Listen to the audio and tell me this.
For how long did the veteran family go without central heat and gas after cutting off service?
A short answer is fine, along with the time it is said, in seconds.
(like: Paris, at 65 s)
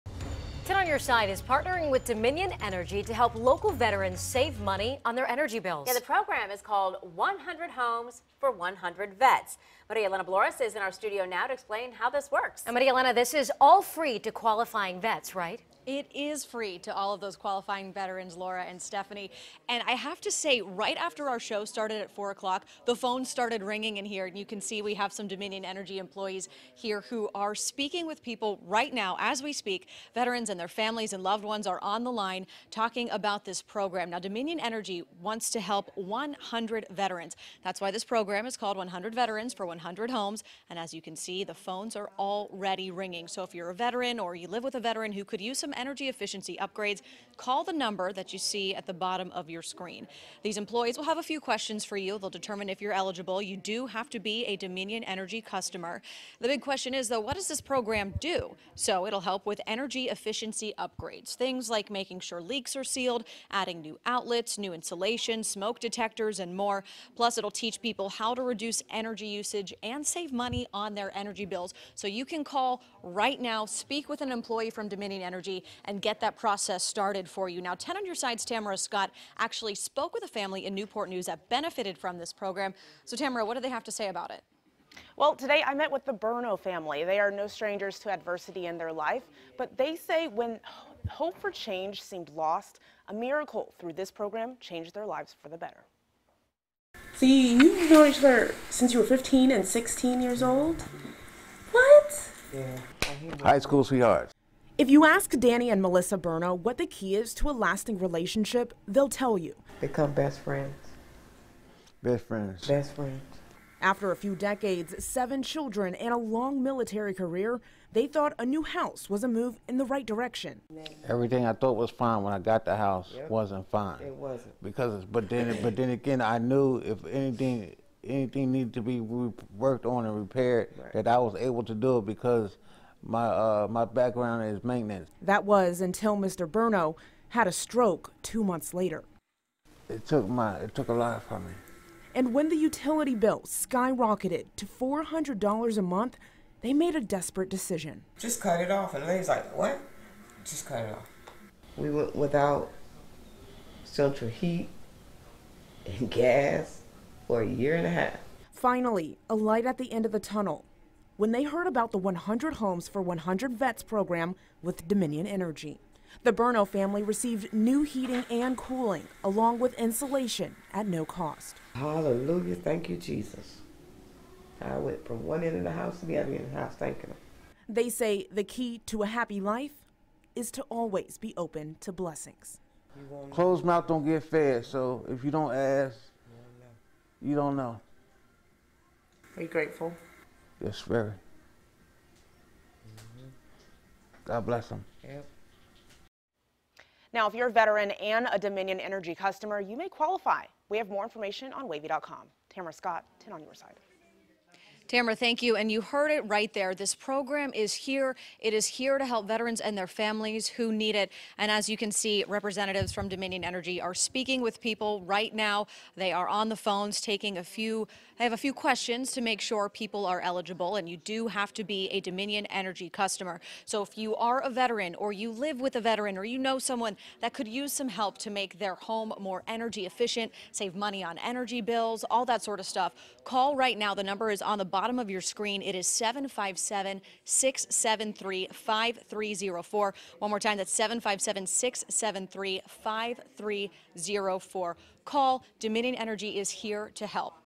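1.5 years, at 157 s.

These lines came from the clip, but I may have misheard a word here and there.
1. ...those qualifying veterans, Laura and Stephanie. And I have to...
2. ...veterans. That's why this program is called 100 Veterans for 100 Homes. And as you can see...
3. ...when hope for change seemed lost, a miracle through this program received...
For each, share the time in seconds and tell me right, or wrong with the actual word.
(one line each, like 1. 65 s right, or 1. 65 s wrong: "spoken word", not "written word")
1. 17 s right
2. 36 s right
3. 90 s wrong: "changed", not "received".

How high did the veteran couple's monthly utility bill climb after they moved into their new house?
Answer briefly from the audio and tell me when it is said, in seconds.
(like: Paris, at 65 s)
$400, at 144 s.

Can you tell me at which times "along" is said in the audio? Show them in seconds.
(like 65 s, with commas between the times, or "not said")
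169 s.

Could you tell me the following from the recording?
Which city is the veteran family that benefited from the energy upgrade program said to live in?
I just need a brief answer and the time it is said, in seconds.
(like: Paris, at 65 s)
Newport News, at 80 s.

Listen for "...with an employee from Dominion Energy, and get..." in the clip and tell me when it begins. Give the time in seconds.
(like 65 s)
74 s.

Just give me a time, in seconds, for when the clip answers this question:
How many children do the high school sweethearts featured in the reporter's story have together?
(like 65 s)
115 s.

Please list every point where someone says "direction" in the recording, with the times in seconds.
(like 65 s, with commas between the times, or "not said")
120 s.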